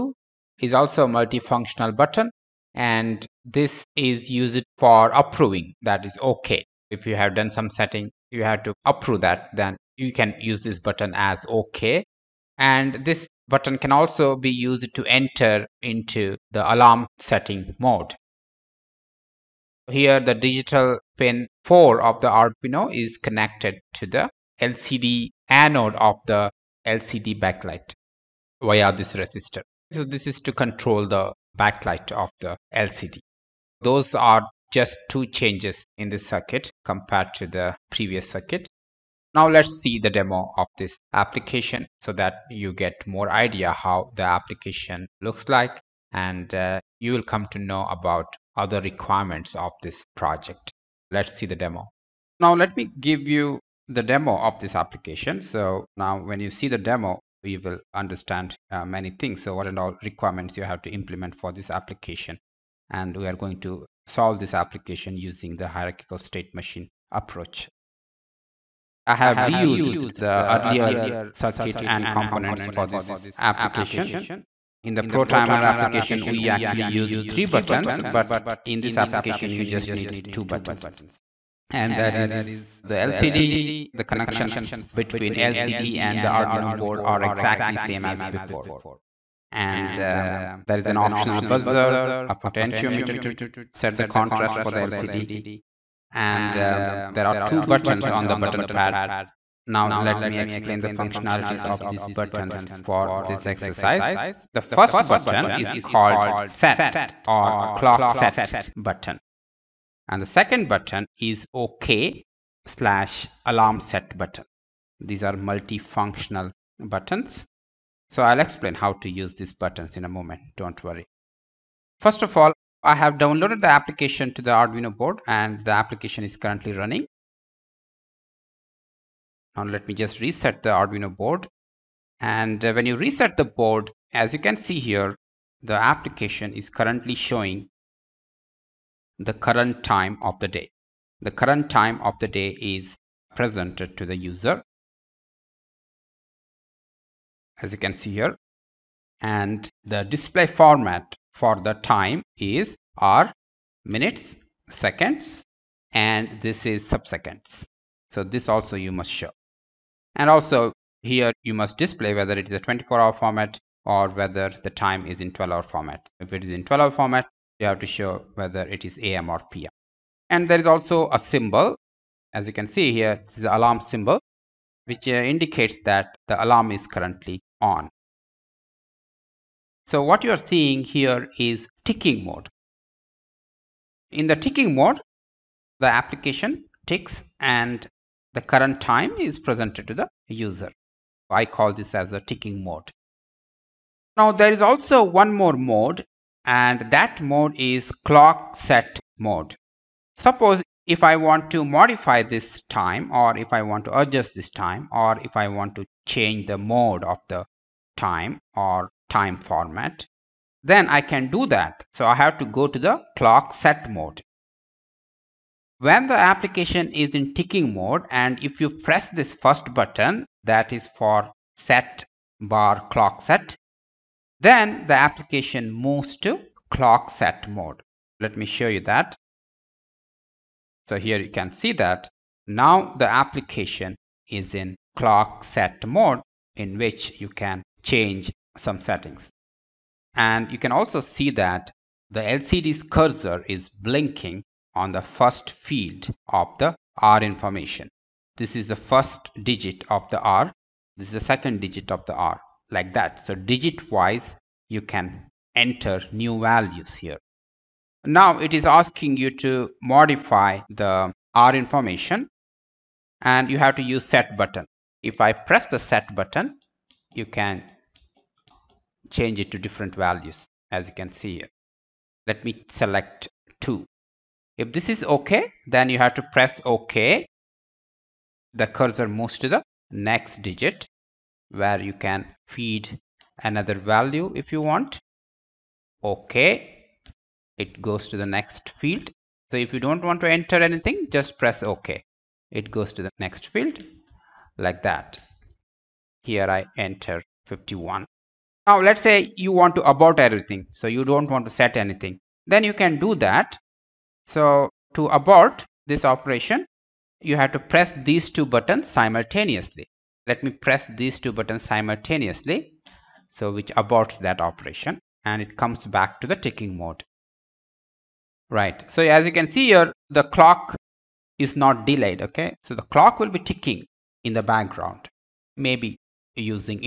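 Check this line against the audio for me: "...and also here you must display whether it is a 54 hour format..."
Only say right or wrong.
wrong.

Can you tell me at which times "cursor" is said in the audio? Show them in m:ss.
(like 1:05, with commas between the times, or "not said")
4:02, 4:38.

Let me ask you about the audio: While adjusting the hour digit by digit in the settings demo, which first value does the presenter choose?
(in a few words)
2.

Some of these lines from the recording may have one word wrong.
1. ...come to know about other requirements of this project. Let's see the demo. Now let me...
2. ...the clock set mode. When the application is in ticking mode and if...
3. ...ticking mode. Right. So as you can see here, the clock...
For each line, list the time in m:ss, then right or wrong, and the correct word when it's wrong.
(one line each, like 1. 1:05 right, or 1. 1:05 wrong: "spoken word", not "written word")
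1. 0:47 right
2. 3:32 right
3. 5:16 right.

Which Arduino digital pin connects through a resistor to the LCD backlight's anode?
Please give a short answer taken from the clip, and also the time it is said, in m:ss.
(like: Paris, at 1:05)
4, at 0:20.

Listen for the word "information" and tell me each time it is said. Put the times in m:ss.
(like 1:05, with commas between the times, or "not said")
4:07, 4:21.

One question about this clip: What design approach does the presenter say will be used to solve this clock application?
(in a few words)
Hierarchical state machine.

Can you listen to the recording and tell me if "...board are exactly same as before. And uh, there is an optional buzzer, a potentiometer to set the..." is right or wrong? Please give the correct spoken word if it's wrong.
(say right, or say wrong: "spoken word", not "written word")
right.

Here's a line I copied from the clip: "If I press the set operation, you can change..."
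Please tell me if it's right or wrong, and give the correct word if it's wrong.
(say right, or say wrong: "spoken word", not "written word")
wrong: "button", not "operation".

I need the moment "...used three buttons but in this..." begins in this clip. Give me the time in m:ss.
1:16.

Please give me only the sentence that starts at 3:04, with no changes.
In the ticking mode, the application ticks and the current time is presented to the user.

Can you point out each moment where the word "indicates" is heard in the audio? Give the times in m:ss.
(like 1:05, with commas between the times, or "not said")
2:55.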